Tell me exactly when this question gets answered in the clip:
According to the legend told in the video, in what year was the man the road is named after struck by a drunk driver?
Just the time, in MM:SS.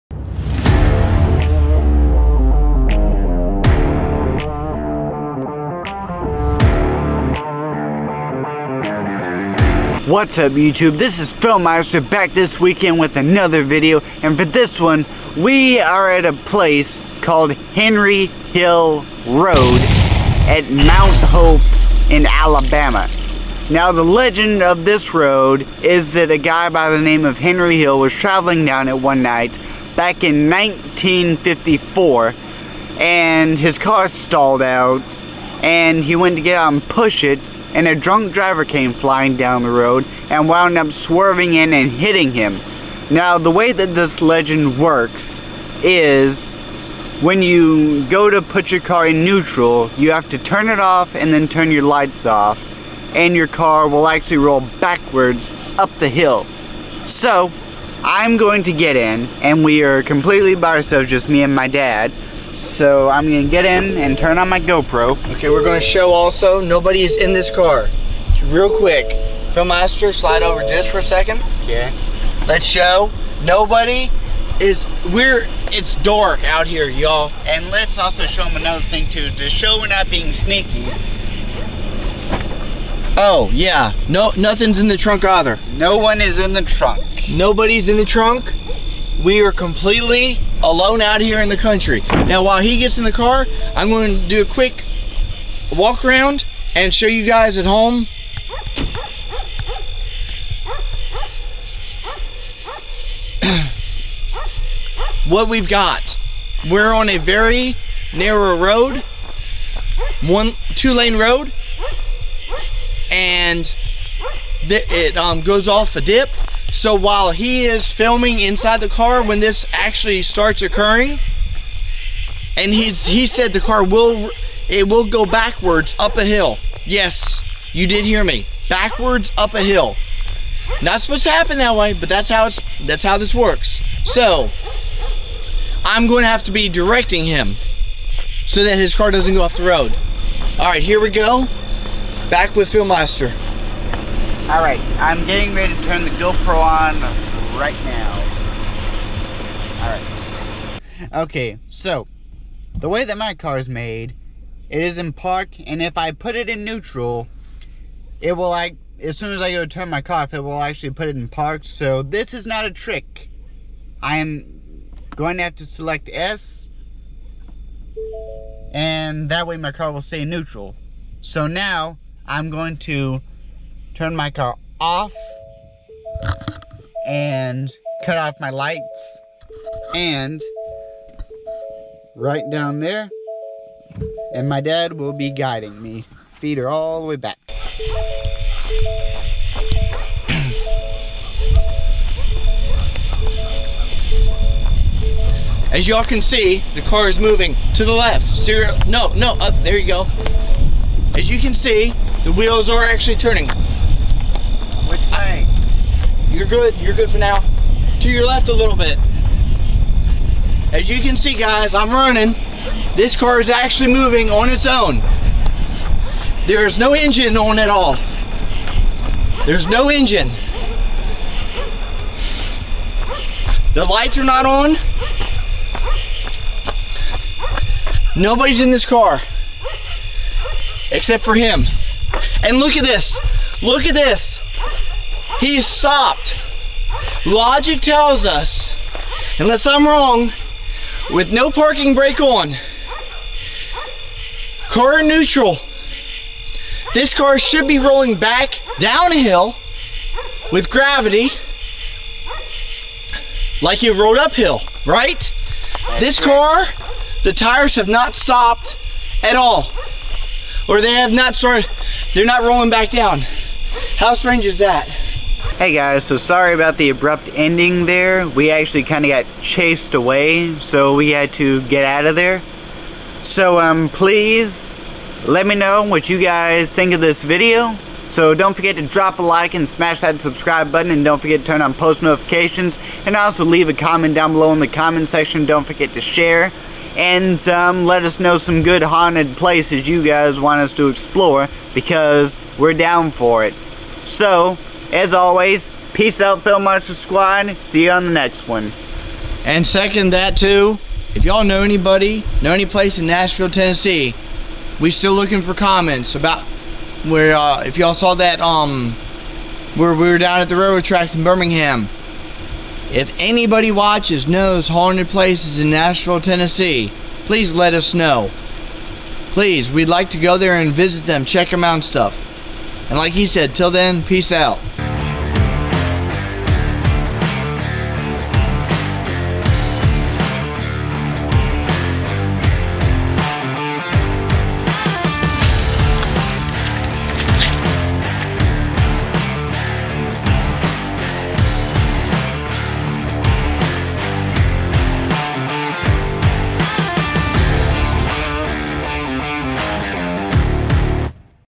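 00:30.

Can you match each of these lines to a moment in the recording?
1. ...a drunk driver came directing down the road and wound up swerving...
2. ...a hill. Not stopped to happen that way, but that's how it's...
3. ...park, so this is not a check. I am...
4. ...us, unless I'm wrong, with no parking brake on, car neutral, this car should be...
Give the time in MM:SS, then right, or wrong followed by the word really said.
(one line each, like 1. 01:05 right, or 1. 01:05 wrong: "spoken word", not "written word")
1. 00:37 wrong: "flying", not "directing"
2. 02:09 wrong: "supposed", not "stopped"
3. 02:41 wrong: "trick", not "check"
4. 03:58 right.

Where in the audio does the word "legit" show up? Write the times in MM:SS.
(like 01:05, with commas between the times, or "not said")
not said.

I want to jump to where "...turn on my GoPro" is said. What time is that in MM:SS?
01:04.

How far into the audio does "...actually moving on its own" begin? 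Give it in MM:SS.
03:33.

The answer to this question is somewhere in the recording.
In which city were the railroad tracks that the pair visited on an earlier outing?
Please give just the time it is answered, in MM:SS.
05:11.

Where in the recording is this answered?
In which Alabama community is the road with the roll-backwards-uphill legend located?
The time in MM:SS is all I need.
00:20.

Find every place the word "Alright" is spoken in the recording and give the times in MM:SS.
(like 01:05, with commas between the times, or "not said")
02:24, 02:29.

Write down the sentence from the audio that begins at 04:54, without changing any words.
So as always, peace out, Film Monster Squad.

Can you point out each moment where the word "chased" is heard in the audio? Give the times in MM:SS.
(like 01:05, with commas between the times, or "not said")
04:29.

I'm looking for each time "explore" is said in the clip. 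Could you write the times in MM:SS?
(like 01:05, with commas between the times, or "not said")
04:50.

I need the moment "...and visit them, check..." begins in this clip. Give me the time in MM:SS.
05:20.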